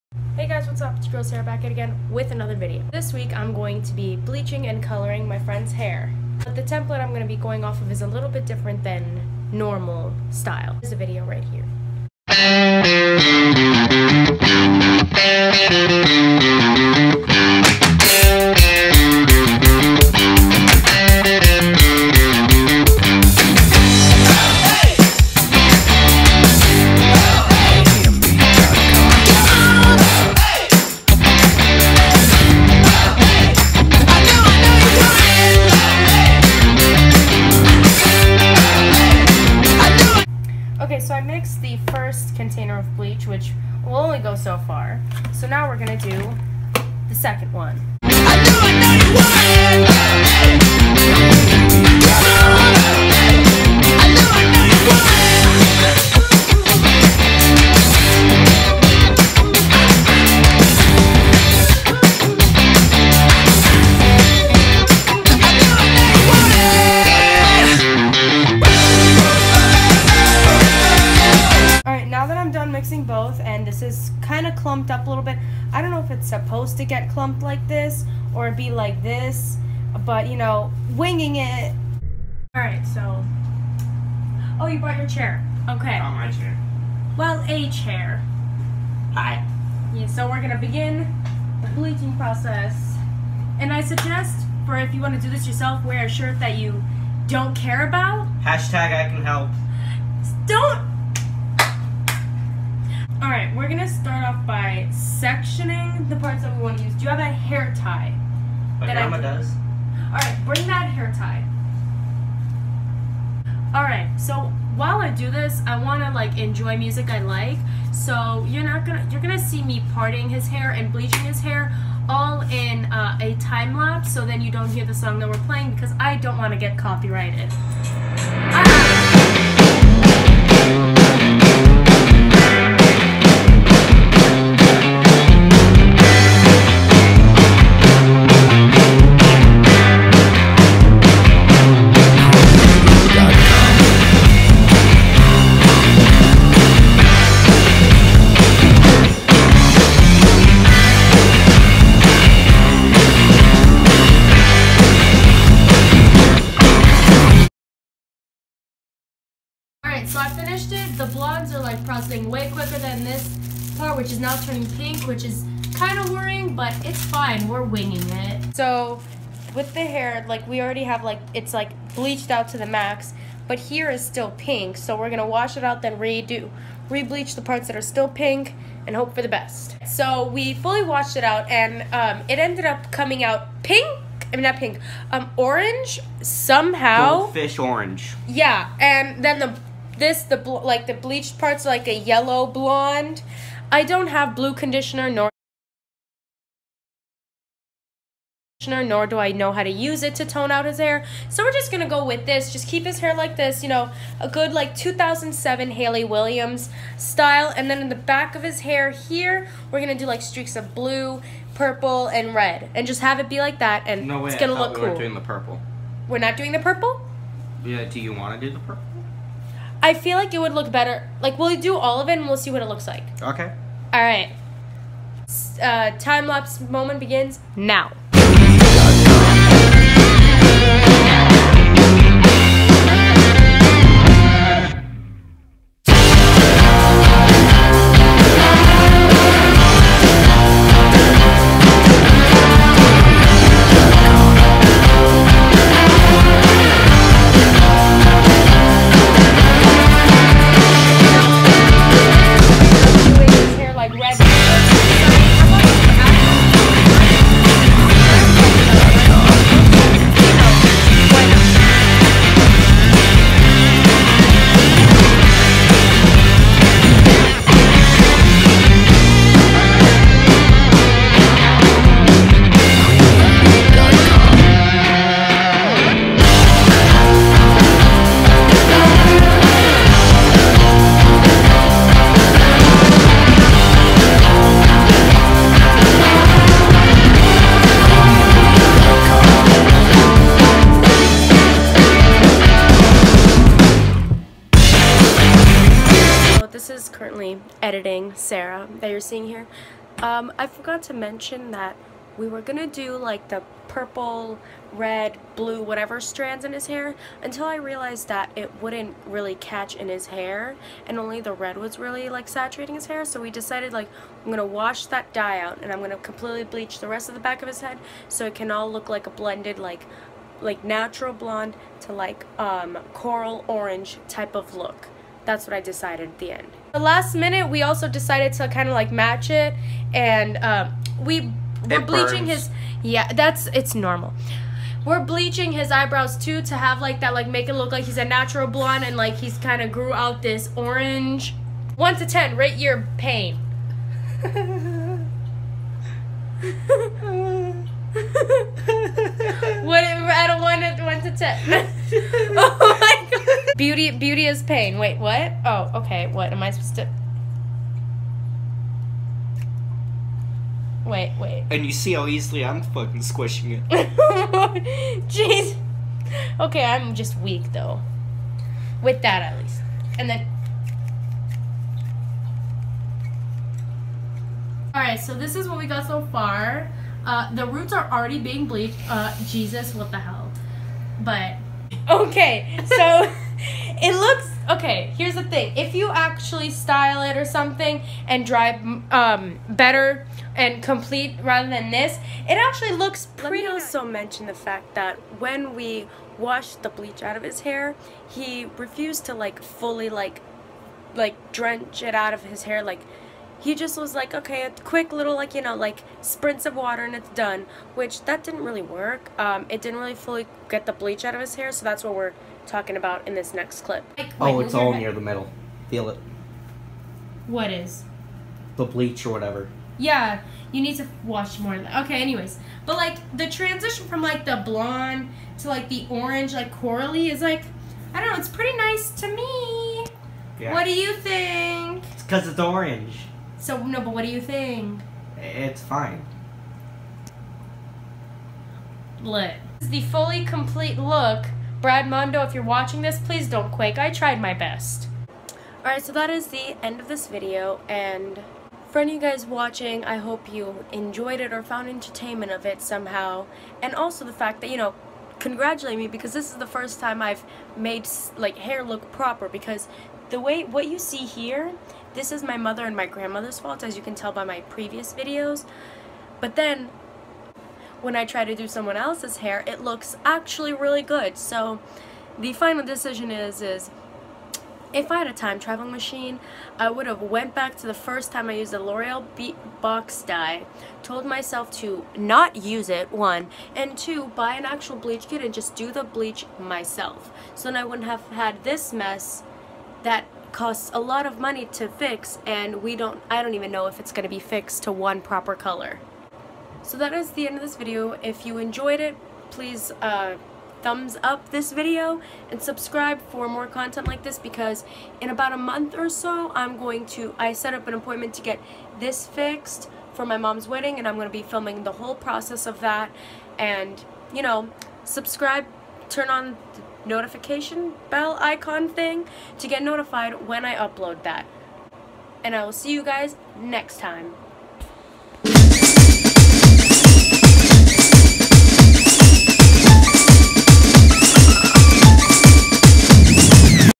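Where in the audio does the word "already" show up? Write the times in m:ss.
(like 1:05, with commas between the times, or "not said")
2:50, 6:17.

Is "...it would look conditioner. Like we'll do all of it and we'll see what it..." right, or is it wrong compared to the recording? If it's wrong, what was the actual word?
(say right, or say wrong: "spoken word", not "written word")
wrong: "better", not "conditioner".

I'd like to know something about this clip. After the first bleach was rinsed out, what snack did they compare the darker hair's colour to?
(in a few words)
Goldfish.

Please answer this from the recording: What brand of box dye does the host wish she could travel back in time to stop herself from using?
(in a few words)
L'Oreal.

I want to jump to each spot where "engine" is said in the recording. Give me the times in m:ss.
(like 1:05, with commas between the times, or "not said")
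not said.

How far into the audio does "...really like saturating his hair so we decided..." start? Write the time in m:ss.
5:11.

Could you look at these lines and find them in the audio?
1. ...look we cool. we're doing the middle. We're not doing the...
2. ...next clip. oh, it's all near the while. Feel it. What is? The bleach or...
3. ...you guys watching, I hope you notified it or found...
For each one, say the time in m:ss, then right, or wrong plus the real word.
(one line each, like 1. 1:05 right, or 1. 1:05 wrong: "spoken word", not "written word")
1. 3:34 wrong: "purple", not "middle"
2. 6:53 wrong: "middle", not "while"
3. 7:29 wrong: "enjoyed", not "notified".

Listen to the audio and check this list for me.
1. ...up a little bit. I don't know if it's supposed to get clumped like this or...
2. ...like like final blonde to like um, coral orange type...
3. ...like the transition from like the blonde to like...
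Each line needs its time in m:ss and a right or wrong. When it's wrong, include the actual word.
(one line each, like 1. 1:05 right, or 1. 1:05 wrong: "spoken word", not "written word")
1. 1:14 right
2. 5:19 wrong: "natural", not "final"
3. 7:02 right.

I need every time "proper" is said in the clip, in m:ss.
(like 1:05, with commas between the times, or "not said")
7:38, 8:15.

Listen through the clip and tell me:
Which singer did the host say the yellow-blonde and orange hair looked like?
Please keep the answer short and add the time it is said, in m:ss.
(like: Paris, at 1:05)
Hayley Williams, at 3:25.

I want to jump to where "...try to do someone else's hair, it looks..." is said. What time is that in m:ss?
7:48.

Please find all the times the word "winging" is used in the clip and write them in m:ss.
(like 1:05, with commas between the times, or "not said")
1:20, 2:47.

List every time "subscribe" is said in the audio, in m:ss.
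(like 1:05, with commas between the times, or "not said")
8:22, 8:34.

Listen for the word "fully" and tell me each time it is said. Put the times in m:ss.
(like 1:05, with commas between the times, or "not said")
3:00, 6:39, 6:49, 7:19.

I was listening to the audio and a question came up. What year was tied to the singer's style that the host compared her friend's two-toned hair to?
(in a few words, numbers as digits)
2007.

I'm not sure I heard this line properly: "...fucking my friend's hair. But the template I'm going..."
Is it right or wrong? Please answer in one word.
wrong.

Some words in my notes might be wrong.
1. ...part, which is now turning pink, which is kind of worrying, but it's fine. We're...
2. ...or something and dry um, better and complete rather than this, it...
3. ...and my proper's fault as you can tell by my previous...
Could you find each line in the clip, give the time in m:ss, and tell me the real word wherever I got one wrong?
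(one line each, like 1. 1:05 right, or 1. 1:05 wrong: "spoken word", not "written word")
1. 2:43 right
2. 6:27 right
3. 7:42 wrong: "grandmother", not "proper".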